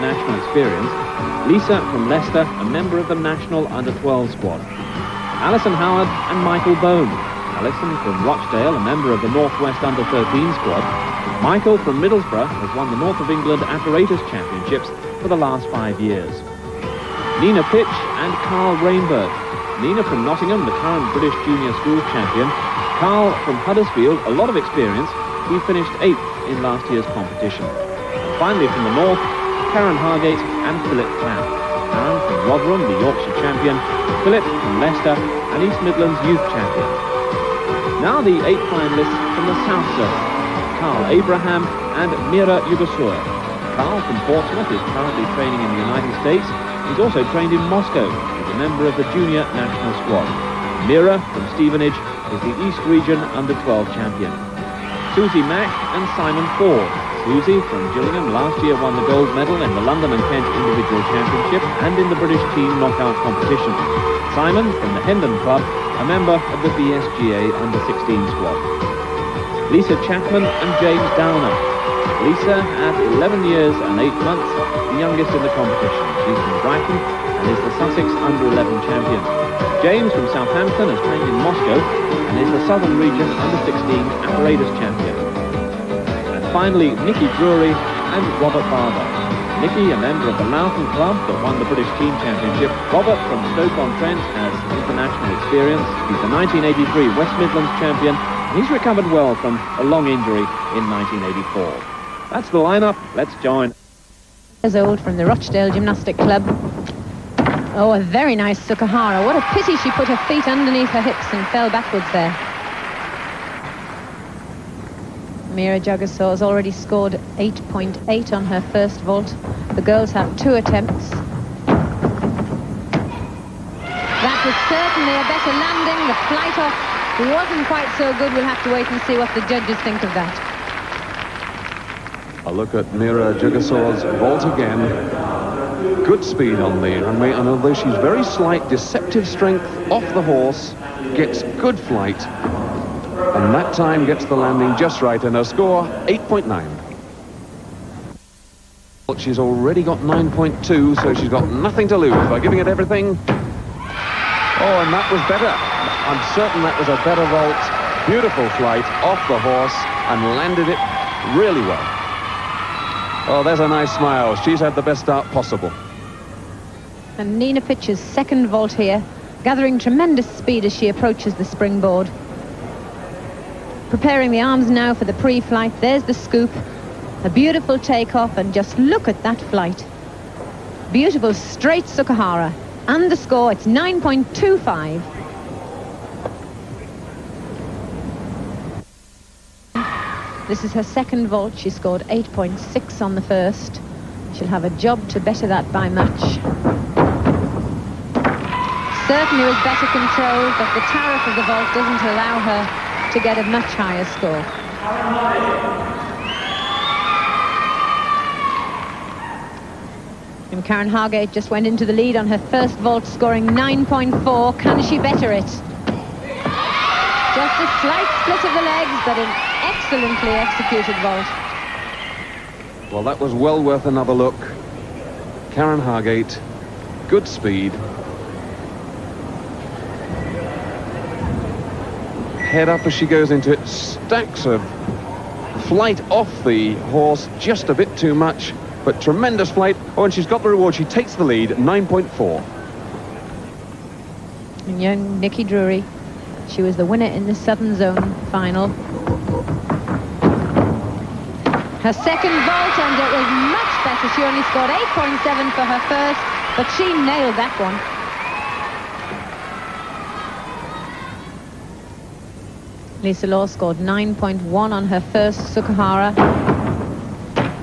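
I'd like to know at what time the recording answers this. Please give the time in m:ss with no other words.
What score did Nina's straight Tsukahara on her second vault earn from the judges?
3:03.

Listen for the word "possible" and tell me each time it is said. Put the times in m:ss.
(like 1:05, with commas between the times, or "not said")
2:45.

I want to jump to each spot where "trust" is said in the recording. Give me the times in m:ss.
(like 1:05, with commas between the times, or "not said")
not said.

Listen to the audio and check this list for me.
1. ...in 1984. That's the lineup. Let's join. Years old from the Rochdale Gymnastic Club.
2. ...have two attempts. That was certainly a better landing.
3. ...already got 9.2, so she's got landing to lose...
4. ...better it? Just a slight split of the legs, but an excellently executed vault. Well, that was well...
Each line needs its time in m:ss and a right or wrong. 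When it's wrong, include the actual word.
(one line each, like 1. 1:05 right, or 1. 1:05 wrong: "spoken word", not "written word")
1. 1:40 right
2. 2:00 right
3. 2:29 wrong: "nothing", not "landing"
4. 3:34 right.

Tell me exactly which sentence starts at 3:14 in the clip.
She'll have a job to better that by much.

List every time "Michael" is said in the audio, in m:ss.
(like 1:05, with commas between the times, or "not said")
0:06, 0:11.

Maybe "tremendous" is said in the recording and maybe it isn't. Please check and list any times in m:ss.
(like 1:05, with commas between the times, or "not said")
2:49, 3:59.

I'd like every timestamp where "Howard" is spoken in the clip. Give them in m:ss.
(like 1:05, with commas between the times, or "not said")
0:05.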